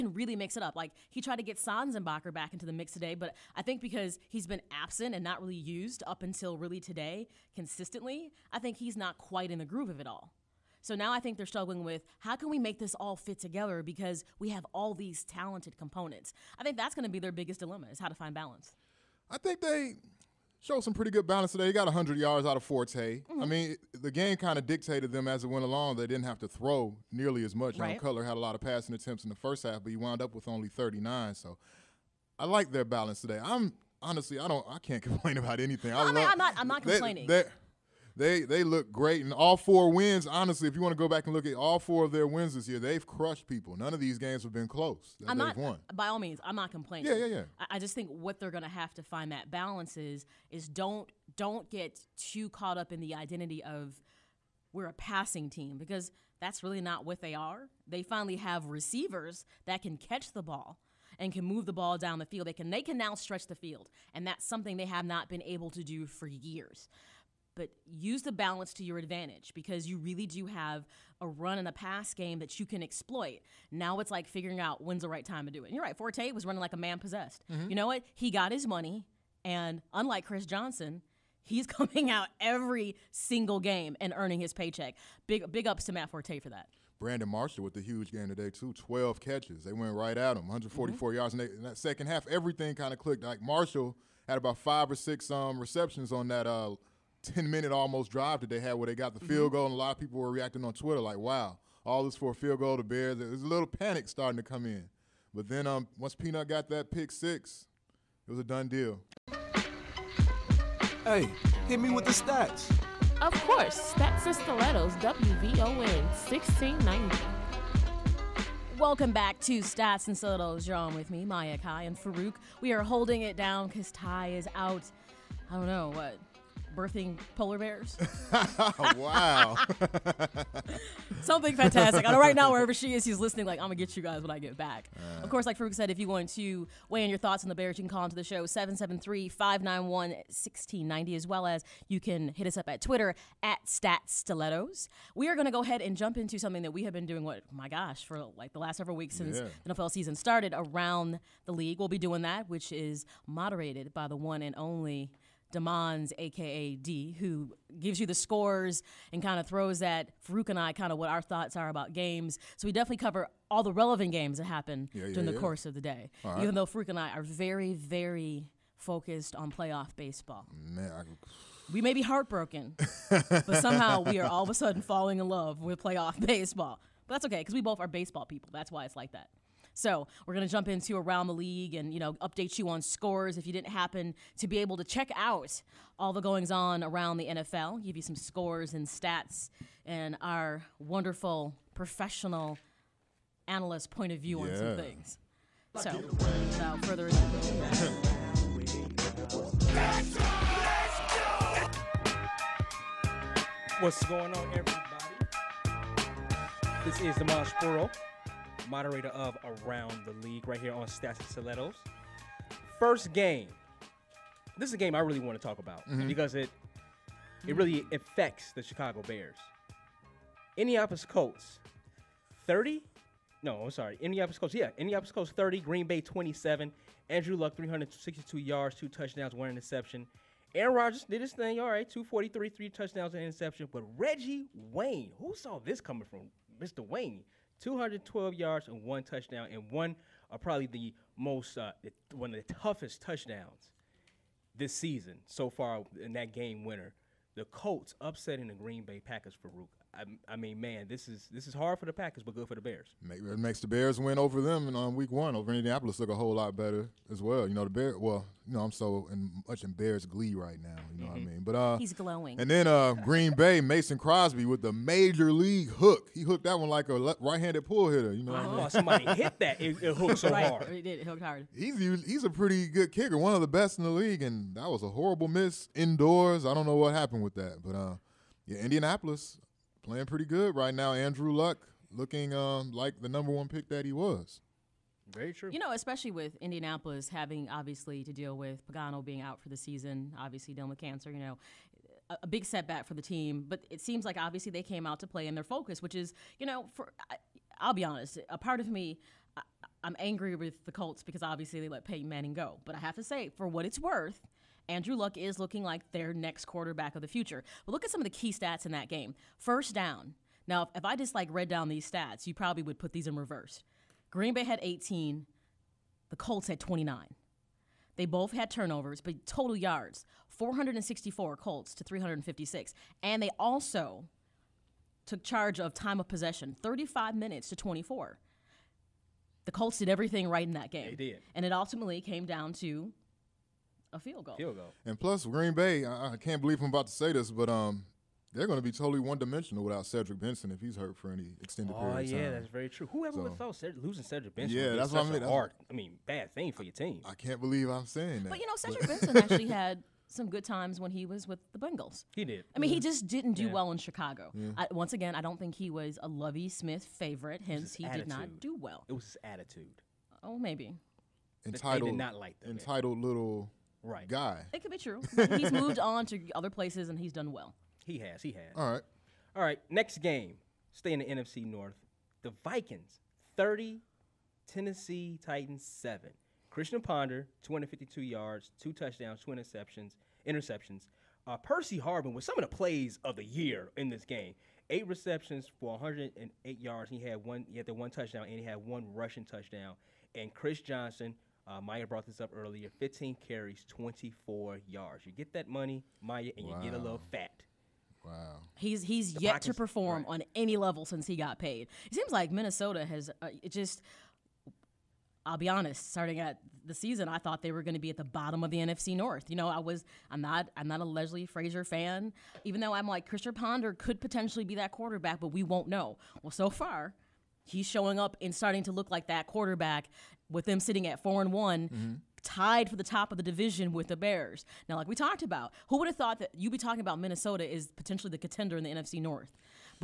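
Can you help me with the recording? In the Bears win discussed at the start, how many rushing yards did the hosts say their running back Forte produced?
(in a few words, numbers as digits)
100.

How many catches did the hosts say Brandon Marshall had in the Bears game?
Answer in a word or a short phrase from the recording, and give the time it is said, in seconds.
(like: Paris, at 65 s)
12, at 88 s.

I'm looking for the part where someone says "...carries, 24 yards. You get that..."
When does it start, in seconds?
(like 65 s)
393 s.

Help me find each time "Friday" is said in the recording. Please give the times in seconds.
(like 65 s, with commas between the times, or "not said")
not said.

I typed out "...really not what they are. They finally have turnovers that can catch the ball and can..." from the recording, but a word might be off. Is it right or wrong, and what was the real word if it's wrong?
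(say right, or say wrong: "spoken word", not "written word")
wrong: "receivers", not "turnovers".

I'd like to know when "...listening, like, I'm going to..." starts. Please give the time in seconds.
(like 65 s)
133 s.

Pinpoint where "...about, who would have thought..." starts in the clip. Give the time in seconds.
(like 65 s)
425 s.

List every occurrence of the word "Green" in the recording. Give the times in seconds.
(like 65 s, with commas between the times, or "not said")
225 s, 248 s, 262 s, 314 s, 335 s.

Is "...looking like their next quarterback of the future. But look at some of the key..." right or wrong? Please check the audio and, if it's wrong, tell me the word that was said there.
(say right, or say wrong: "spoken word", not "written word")
right.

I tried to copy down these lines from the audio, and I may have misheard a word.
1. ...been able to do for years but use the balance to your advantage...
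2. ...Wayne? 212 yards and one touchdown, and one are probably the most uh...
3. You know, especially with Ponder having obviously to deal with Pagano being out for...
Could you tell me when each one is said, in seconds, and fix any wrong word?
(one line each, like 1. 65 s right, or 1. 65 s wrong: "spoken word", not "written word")
1. 65 s right
2. 236 s right
3. 285 s wrong: "Indianapolis", not "Ponder".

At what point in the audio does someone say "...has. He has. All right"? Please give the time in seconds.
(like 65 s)
367 s.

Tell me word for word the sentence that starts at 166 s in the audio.
Even though Farouk and I are very, very focused on playoff baseball.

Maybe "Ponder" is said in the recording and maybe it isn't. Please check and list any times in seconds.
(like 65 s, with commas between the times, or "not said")
376 s, 413 s.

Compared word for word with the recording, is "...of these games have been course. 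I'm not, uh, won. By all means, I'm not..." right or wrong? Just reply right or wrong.
wrong.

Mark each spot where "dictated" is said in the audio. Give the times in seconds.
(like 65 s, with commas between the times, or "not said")
24 s.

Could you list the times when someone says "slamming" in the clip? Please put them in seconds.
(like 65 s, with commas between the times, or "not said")
not said.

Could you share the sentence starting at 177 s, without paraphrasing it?
But that's okay because we both are baseball people.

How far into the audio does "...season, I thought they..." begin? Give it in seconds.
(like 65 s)
406 s.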